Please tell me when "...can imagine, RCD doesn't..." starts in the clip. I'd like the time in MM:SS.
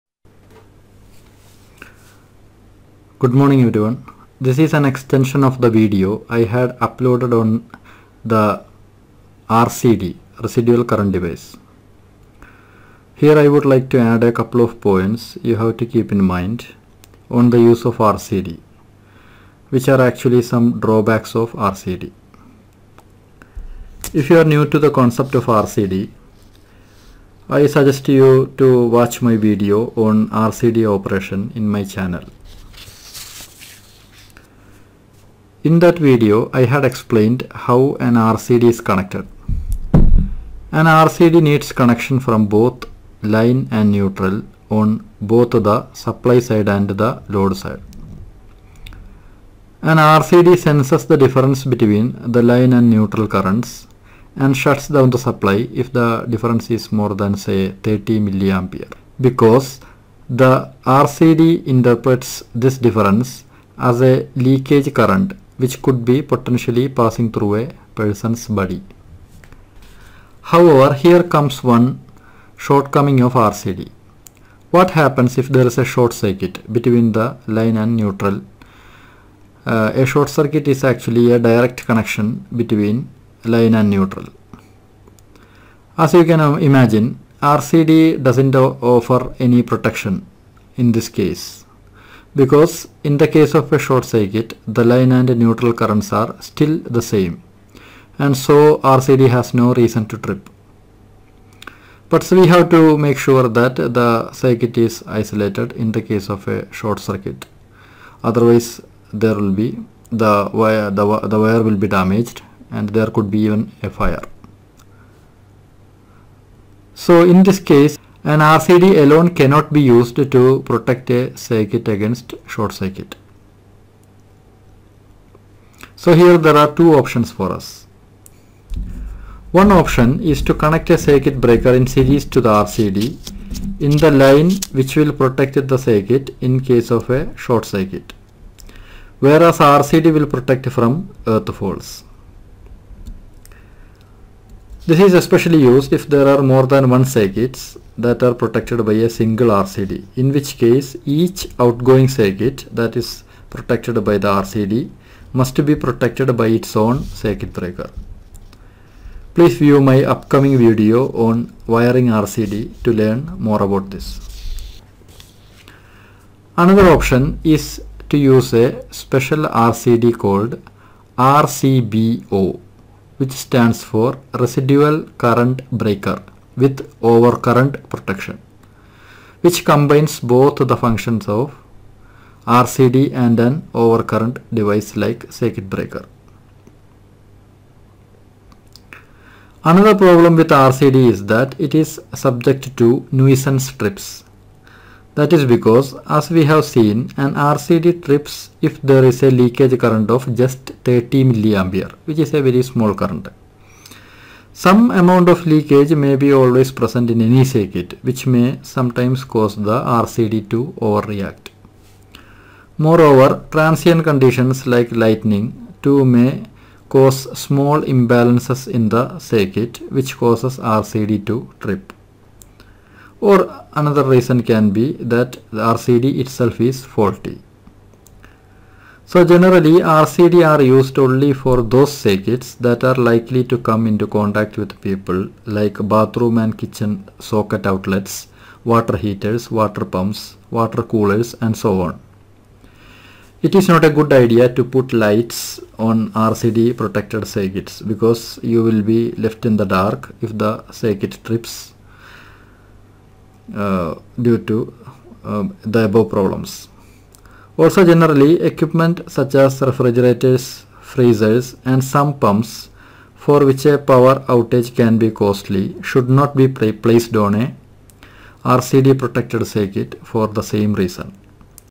01:26.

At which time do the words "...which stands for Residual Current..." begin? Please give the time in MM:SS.
02:53.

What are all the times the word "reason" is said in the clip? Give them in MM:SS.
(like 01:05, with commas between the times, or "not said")
01:39, 03:44, 04:30.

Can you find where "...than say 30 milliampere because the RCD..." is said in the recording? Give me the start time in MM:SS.
00:57.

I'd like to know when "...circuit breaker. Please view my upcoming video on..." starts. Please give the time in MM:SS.
02:37.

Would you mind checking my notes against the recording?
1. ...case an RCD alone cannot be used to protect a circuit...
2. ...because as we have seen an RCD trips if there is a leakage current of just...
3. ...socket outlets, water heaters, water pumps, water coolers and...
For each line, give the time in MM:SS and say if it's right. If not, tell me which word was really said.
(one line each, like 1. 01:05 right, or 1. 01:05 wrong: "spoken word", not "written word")
1. 01:57 right
2. 03:15 right
3. 03:57 right.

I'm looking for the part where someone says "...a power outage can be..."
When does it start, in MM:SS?
04:23.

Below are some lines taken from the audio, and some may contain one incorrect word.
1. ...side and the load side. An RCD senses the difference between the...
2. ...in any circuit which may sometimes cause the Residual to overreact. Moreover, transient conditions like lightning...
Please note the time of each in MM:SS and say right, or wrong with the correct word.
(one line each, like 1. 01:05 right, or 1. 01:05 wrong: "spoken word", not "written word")
1. 00:46 right
2. 03:27 wrong: "RCD", not "Residual".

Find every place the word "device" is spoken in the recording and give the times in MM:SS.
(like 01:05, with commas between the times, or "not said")
00:11, 03:04.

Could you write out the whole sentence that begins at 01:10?
However, here comes one shortcoming of RCD.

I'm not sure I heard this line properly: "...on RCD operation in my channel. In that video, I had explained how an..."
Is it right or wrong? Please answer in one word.
right.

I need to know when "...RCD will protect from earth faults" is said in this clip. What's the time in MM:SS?
02:19.